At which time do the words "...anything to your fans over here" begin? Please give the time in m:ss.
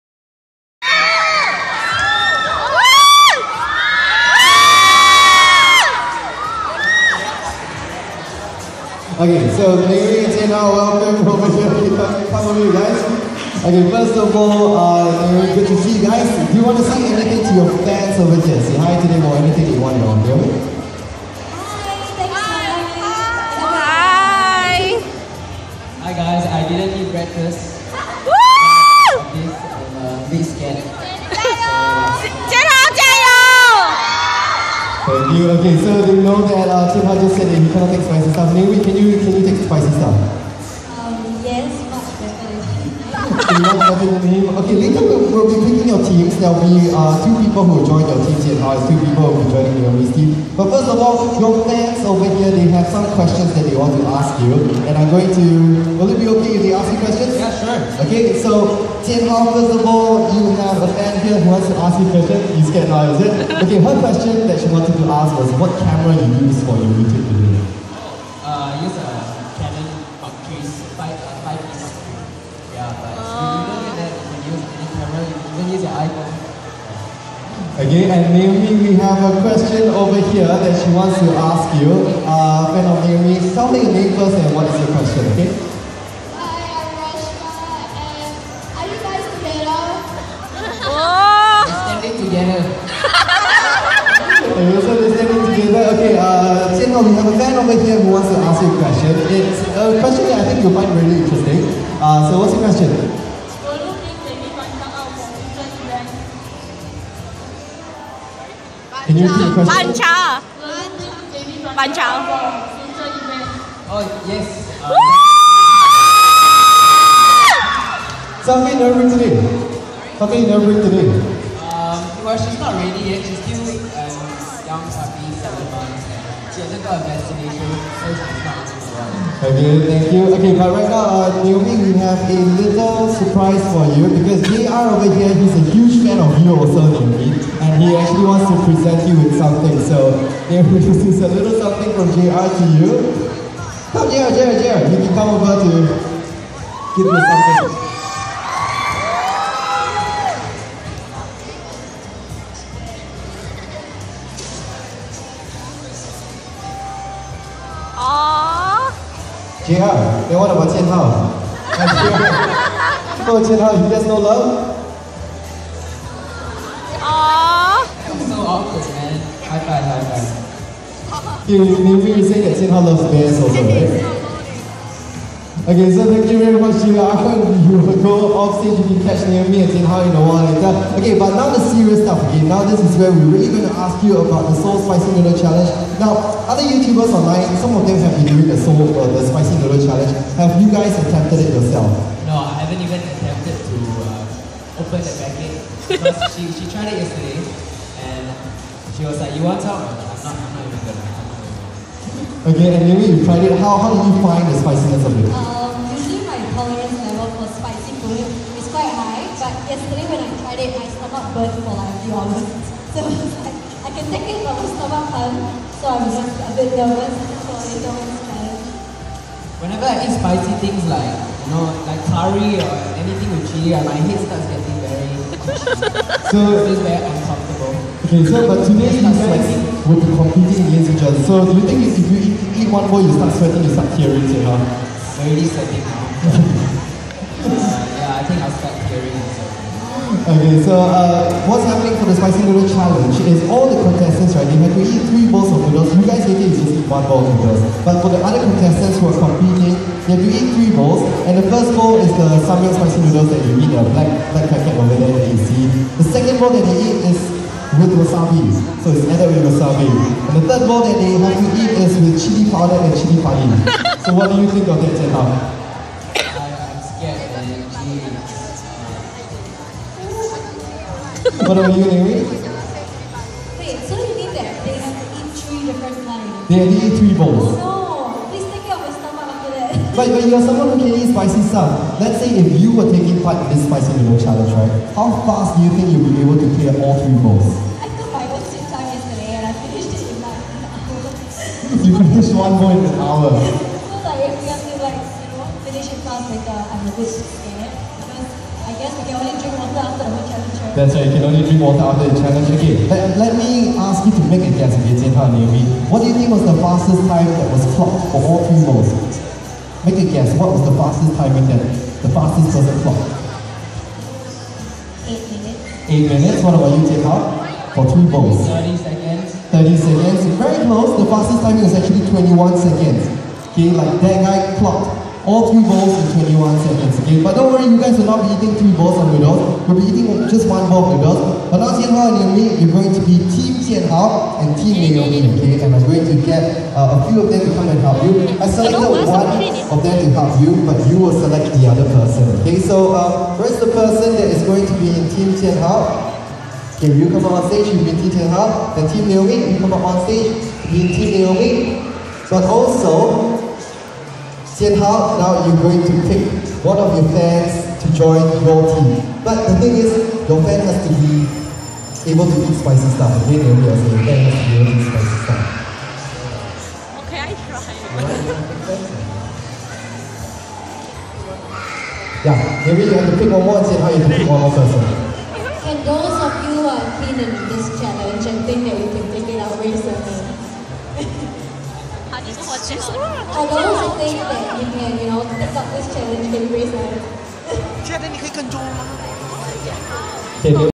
0:17.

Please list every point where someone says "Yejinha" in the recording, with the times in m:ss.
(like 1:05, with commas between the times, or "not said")
5:04.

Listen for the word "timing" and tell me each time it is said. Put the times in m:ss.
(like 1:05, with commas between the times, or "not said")
5:11, 5:21.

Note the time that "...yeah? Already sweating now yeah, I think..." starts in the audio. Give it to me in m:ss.
3:54.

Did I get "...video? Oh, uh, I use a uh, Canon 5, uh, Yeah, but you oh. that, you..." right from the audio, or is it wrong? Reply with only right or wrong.
right.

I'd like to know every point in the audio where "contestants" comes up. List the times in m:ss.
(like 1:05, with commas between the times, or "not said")
4:03, 4:08.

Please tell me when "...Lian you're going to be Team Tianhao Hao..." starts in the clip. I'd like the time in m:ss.
5:32.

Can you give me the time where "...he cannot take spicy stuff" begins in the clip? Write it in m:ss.
0:37.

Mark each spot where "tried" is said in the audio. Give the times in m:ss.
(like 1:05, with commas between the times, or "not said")
3:16, 3:23, 3:30.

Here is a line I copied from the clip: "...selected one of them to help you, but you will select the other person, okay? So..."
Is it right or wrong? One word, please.
right.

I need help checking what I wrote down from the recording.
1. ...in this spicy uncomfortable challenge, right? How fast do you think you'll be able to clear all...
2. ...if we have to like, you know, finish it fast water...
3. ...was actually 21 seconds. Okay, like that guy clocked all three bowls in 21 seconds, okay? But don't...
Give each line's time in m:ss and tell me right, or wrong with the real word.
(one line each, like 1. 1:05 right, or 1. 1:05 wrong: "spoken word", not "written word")
1. 4:43 wrong: "noodle", not "uncomfortable"
2. 4:54 wrong: "later", not "water"
3. 5:21 right.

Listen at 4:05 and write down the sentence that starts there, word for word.
You guys later you just eat one bowl of noodles.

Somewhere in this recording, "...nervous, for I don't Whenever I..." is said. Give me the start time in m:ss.
3:36.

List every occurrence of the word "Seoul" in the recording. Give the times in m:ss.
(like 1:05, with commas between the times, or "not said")
3:04, 3:08.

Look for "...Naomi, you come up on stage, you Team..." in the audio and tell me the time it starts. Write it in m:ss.
5:49.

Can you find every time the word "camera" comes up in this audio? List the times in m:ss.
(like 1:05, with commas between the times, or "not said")
1:05, 1:14.